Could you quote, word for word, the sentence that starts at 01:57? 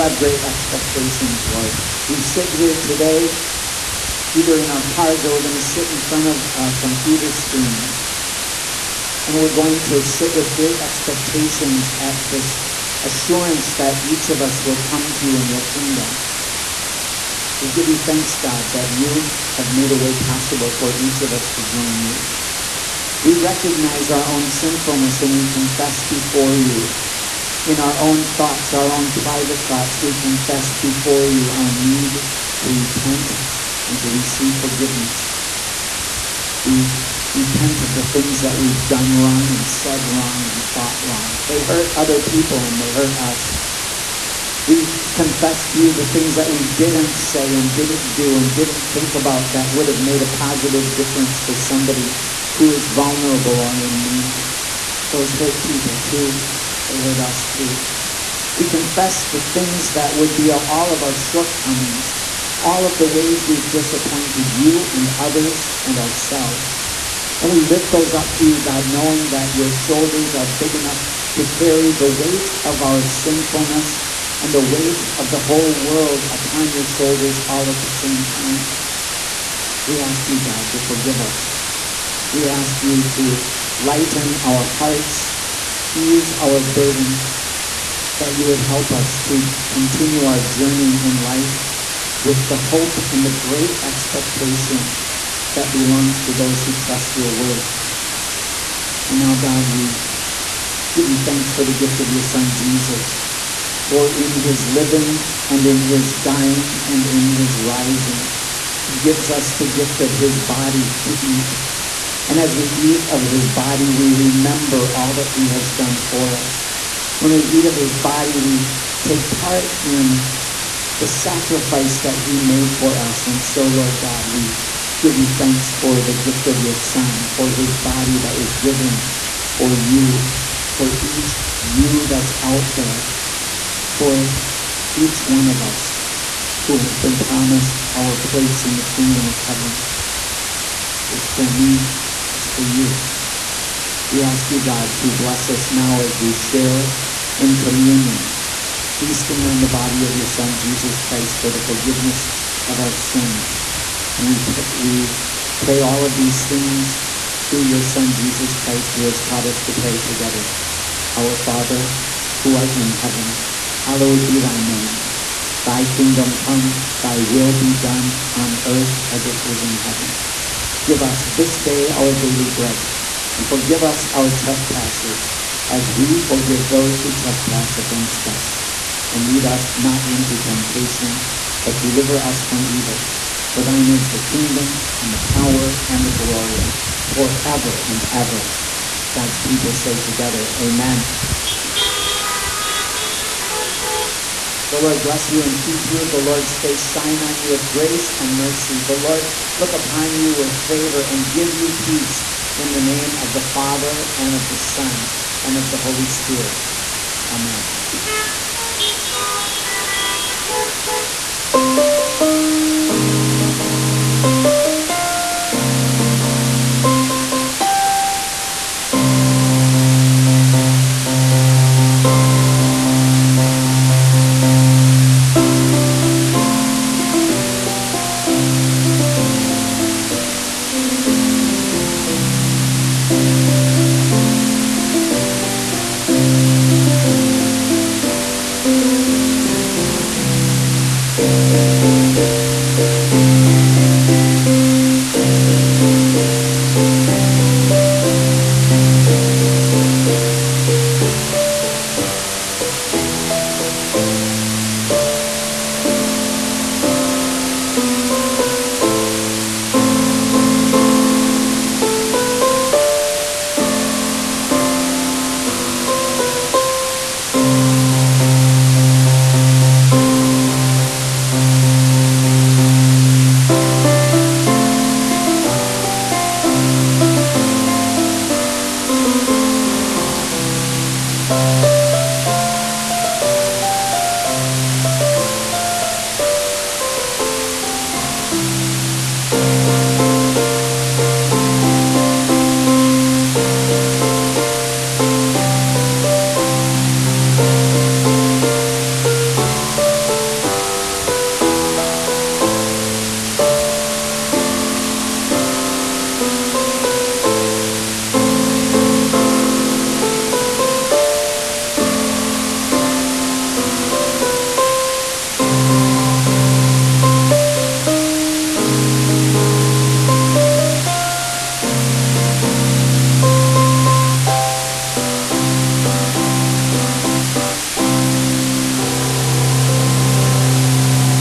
When we eat of his body, we take part in the sacrifice that he made for us.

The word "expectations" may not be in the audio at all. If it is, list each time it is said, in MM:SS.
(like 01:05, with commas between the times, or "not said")
00:00, 00:10, 01:33.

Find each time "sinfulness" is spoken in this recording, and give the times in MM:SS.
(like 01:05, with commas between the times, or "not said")
00:24, 01:13.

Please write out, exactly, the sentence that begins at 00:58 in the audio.
We confess the things that would be all of our shortcomings, all of the ways we've disappointed you and others and ourselves.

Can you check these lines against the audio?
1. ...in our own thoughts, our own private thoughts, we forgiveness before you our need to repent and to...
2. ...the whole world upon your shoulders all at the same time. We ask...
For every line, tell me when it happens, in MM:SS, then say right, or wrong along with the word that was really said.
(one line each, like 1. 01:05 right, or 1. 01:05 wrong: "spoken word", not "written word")
1. 00:27 wrong: "confess", not "forgiveness"
2. 01:15 right.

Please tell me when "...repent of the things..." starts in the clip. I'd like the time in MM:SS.
00:37.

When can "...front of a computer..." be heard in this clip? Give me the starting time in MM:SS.
00:05.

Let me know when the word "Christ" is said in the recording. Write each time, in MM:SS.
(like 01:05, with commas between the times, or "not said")
02:30, 02:38.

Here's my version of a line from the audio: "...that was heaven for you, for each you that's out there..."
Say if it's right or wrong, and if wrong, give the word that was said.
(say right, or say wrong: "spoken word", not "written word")
wrong: "given", not "heaven".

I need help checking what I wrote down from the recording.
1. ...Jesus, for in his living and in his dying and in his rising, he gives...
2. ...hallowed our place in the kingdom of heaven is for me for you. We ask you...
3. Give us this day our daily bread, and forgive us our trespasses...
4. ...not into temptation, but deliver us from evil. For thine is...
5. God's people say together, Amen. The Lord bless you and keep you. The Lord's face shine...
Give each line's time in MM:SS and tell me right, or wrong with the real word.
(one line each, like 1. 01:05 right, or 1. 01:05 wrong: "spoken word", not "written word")
1. 01:42 right
2. 02:17 wrong: "promised", not "hallowed"
3. 02:50 right
4. 02:59 right
5. 03:09 right.